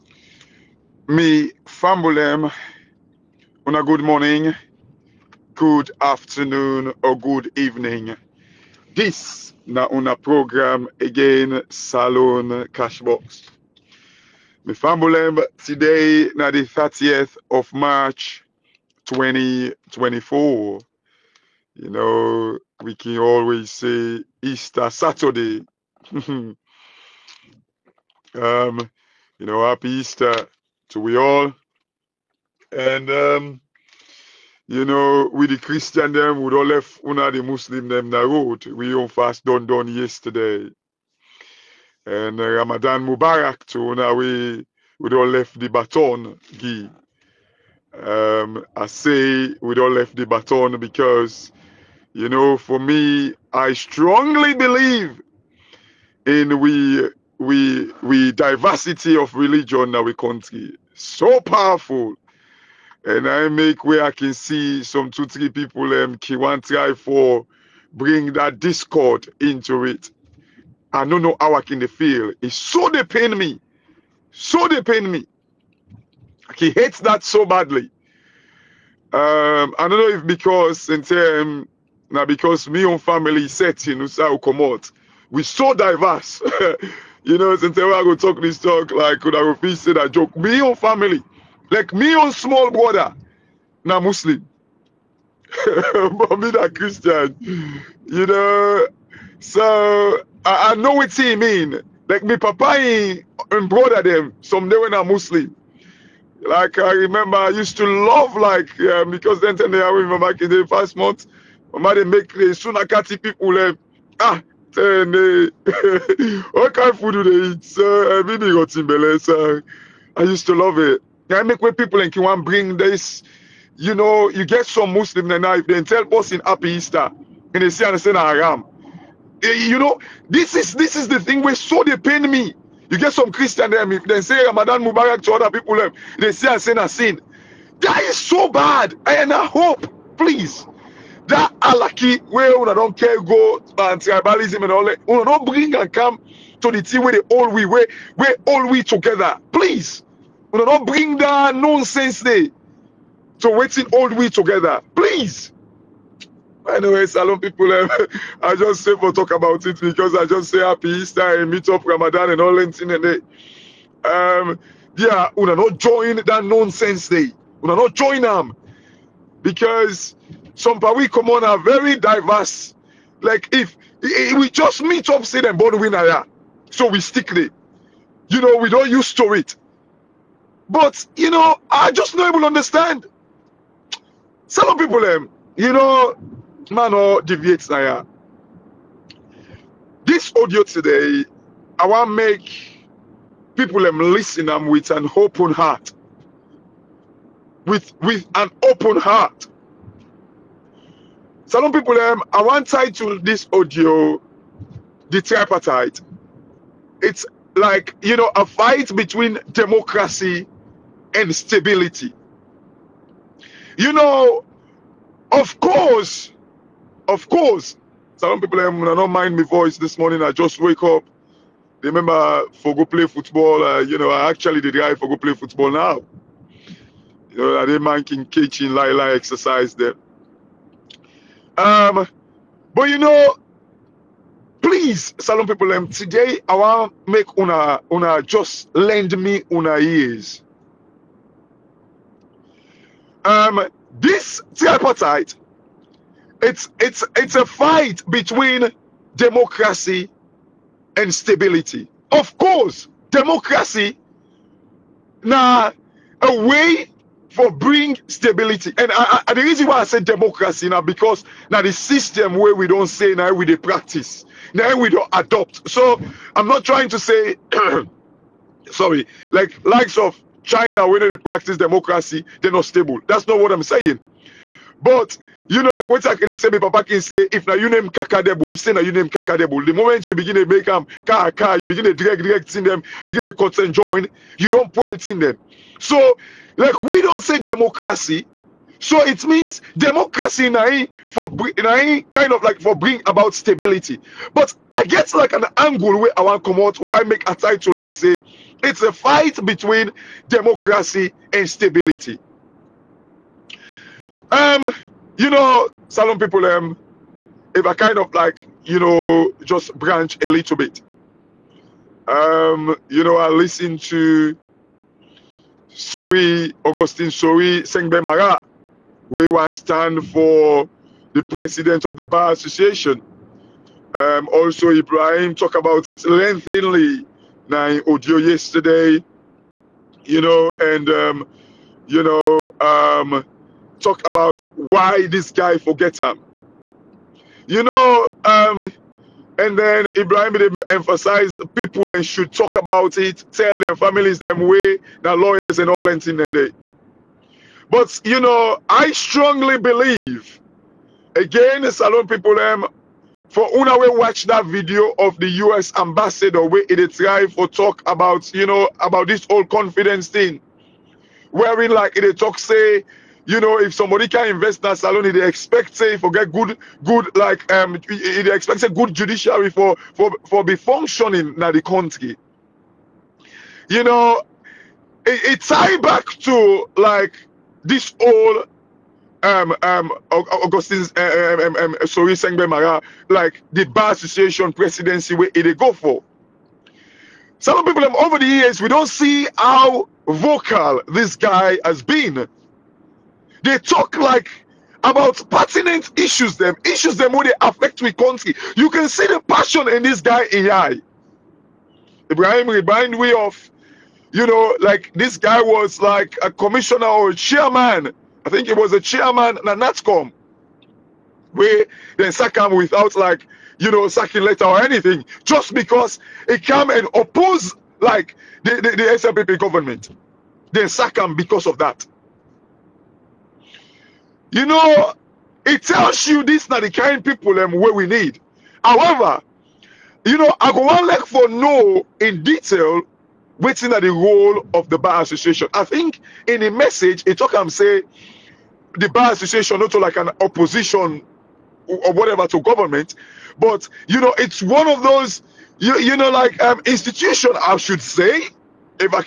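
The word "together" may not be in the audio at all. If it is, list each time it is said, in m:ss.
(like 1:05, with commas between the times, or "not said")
2:28, 2:34.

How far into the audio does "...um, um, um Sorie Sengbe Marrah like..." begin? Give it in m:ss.
6:21.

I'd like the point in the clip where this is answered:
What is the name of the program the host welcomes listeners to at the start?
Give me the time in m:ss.
0:11.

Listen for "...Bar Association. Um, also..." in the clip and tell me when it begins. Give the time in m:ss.
5:22.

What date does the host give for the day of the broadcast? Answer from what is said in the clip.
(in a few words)
30th of March 2024.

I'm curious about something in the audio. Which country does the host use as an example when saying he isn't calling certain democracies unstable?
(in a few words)
China.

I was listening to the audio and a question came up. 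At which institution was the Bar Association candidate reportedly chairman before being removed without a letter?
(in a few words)
NATCOM.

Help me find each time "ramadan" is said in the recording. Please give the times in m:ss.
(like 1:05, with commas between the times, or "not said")
0:42, 2:14, 2:41.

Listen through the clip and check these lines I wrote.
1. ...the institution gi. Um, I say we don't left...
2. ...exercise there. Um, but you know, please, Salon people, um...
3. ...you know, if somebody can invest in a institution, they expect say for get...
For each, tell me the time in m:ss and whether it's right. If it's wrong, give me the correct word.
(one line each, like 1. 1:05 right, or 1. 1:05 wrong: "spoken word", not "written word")
1. 0:45 wrong: "baton", not "institution"
2. 3:49 right
3. 6:03 wrong: "salon", not "institution".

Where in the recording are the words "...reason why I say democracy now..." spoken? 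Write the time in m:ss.
4:19.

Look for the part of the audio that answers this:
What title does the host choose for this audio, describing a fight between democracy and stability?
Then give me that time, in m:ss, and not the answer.
3:25.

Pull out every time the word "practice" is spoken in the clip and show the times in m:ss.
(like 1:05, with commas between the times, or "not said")
4:23, 4:31.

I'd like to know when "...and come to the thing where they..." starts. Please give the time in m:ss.
2:25.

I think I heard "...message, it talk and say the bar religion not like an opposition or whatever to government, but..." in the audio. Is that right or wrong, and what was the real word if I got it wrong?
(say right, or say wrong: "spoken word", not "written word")
wrong: "association", not "religion".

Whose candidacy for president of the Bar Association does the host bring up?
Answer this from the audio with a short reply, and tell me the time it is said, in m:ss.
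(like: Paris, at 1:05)
Augustine Sorie Sengbe Marrah, at 5:16.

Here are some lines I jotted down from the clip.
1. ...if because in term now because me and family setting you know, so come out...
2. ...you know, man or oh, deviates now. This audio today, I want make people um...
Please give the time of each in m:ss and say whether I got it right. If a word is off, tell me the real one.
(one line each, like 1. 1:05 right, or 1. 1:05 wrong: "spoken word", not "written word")
1. 1:20 right
2. 3:05 right.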